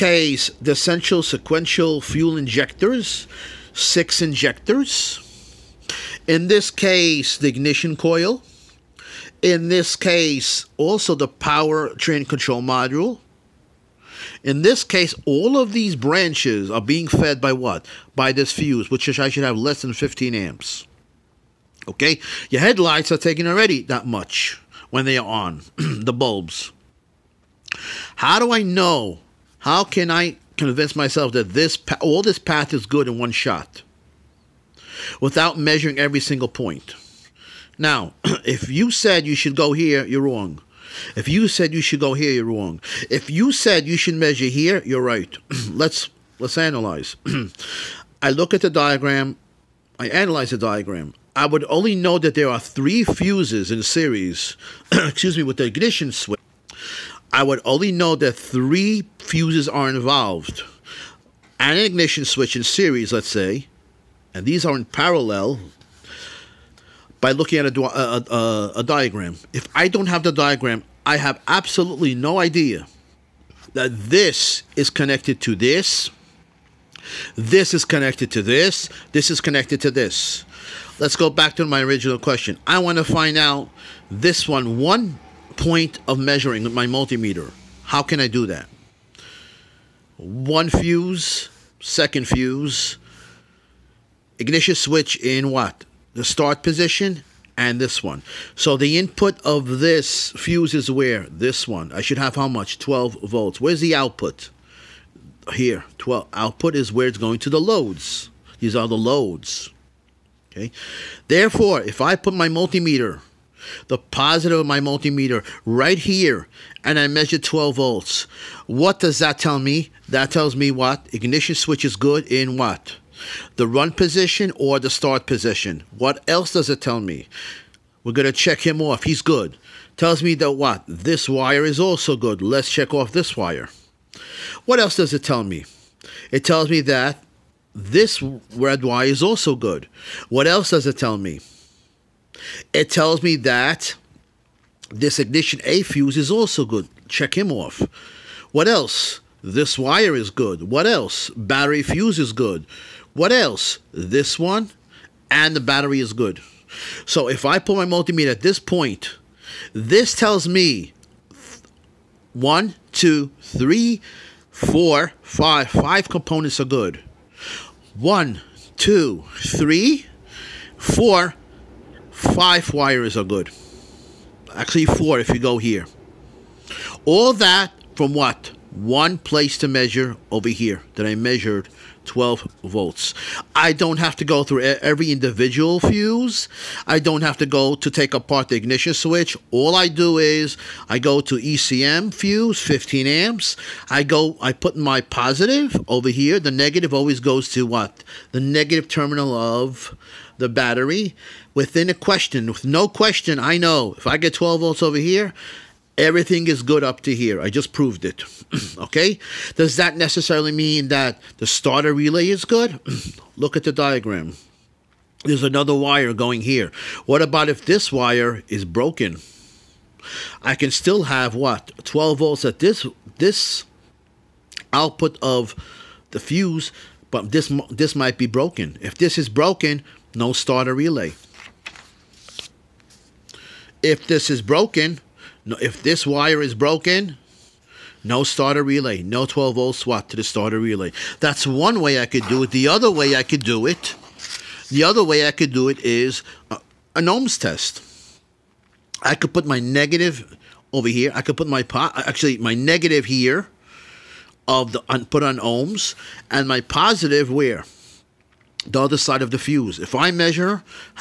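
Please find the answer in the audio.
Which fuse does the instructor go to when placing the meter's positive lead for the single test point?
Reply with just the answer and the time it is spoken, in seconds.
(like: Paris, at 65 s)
ECM fuse, at 191 s.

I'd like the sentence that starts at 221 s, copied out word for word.
12 volts at this this output of the fuse, but this this might be broken.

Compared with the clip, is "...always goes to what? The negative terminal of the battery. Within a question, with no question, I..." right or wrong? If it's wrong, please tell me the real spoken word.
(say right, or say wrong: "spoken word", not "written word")
right.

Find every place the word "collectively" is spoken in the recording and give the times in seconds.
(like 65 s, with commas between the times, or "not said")
not said.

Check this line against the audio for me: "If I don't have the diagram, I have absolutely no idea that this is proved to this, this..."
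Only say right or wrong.
wrong.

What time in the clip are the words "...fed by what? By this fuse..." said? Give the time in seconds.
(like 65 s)
17 s.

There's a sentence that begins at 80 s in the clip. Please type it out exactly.
Let's go back to my original question.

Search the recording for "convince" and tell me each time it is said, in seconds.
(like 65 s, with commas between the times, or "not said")
30 s.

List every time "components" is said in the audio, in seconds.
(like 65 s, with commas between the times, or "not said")
166 s.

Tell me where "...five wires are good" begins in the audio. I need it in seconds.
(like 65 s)
172 s.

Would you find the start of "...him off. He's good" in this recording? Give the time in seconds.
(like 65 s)
128 s.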